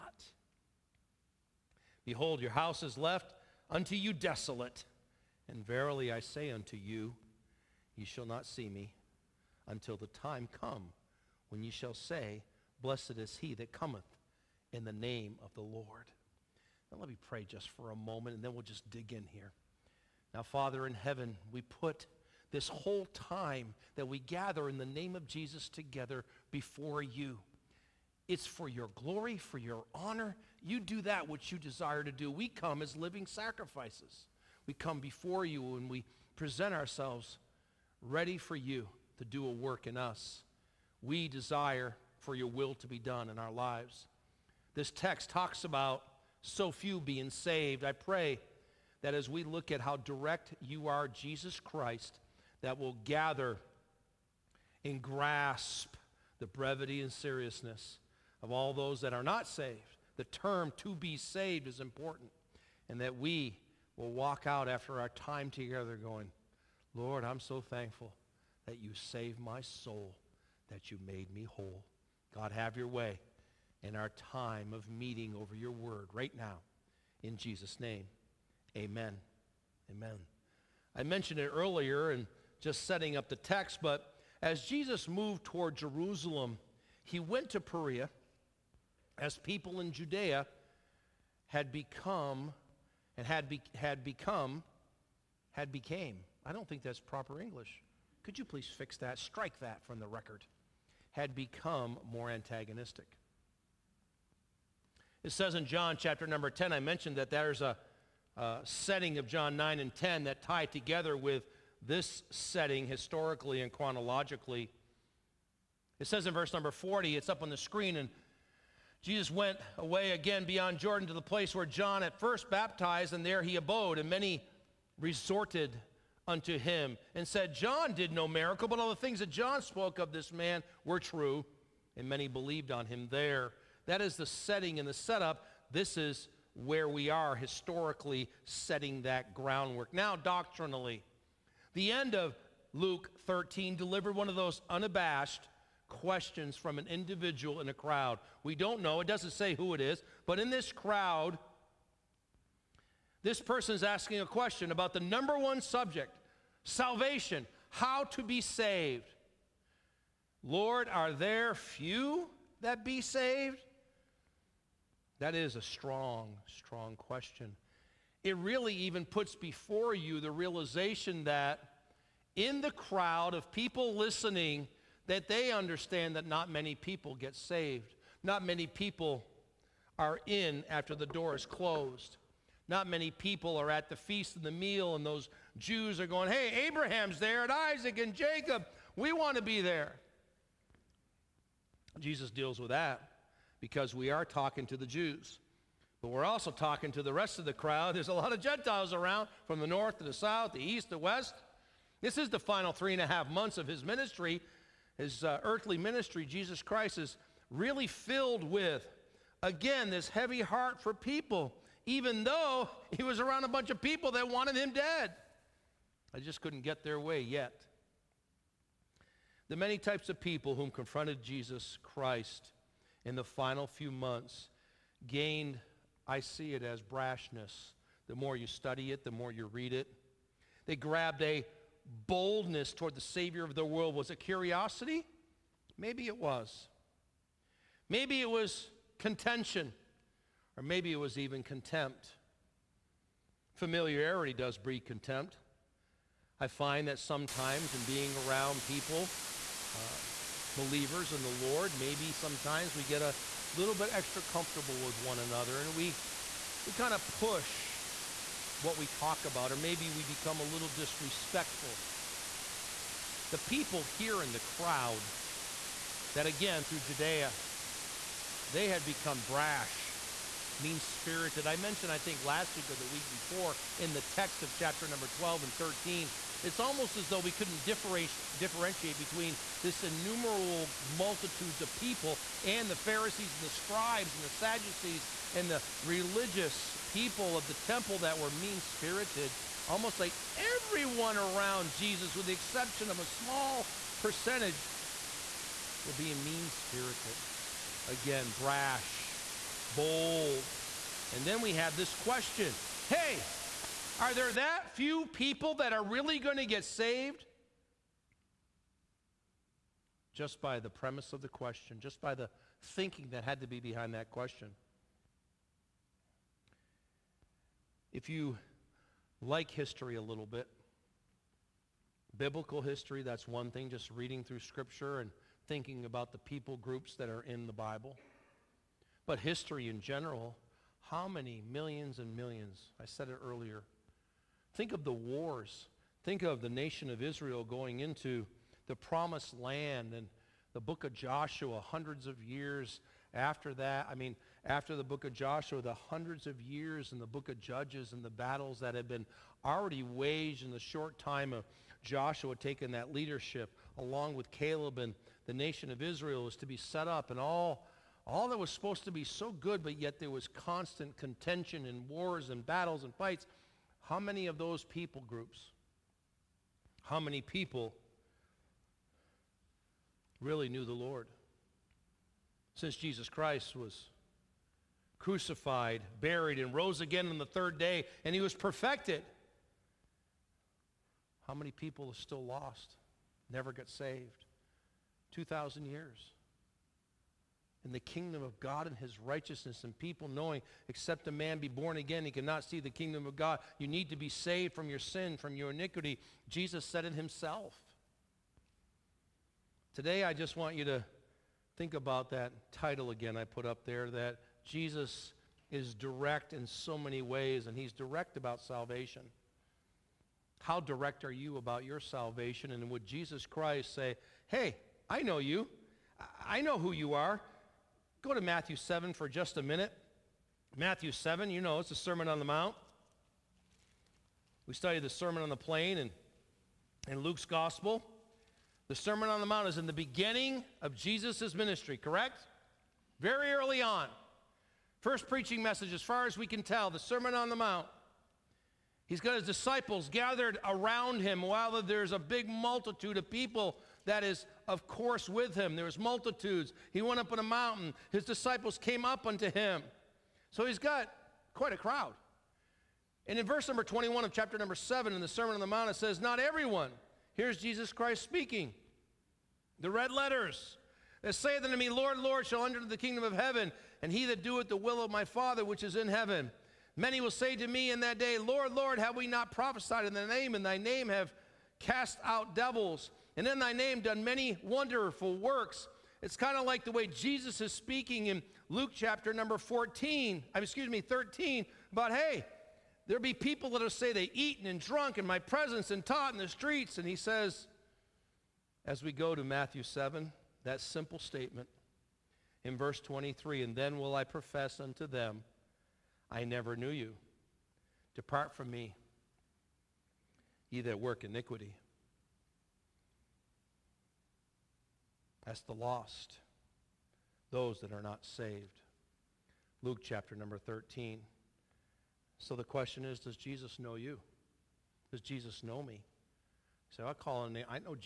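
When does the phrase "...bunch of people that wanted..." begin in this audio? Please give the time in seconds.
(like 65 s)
213 s.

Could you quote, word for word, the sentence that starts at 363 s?
How many of those people groups, how many people really knew the Lord?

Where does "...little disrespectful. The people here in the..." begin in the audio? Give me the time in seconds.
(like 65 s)
260 s.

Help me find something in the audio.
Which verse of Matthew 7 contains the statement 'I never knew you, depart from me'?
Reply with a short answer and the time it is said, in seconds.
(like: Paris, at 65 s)
Verse 23, at 492 s.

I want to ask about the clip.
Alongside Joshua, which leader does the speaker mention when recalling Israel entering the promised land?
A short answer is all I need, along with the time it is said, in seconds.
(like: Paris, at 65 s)
Caleb, at 354 s.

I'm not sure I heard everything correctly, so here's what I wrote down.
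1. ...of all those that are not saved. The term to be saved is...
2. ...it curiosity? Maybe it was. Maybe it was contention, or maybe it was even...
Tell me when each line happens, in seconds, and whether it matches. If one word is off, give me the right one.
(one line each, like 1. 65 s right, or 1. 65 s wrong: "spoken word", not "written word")
1. 58 s right
2. 234 s right.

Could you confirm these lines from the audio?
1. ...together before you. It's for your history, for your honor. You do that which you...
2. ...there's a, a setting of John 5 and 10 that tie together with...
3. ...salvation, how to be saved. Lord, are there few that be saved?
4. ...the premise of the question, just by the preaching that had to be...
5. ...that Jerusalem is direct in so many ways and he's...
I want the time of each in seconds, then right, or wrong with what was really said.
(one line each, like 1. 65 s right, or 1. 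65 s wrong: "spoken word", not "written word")
1. 25 s wrong: "glory", not "history"
2. 107 s wrong: "9", not "5"
3. 156 s right
4. 310 s wrong: "thinking", not "preaching"
5. 403 s wrong: "Jesus", not "Jerusalem".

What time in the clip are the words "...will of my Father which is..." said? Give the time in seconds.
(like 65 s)
464 s.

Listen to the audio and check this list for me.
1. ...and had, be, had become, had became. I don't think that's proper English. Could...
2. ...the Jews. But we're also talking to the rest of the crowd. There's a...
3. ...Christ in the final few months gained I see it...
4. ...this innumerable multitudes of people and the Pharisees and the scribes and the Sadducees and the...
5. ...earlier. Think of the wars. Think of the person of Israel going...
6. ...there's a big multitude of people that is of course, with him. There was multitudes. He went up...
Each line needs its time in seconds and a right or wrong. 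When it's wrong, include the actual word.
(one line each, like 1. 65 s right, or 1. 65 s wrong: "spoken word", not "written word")
1. 93 s right
2. 194 s right
3. 221 s right
4. 279 s right
5. 333 s wrong: "nation", not "person"
6. 441 s right.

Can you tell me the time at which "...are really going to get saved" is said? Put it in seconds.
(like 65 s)
305 s.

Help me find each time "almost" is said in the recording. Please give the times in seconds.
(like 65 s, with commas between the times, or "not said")
276 s, 289 s.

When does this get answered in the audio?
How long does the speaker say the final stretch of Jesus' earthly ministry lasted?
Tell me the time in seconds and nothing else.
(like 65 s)
202 s.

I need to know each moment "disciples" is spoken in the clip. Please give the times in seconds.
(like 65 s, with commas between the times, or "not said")
439 s, 448 s.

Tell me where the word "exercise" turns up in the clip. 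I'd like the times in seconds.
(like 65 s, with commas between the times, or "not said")
not said.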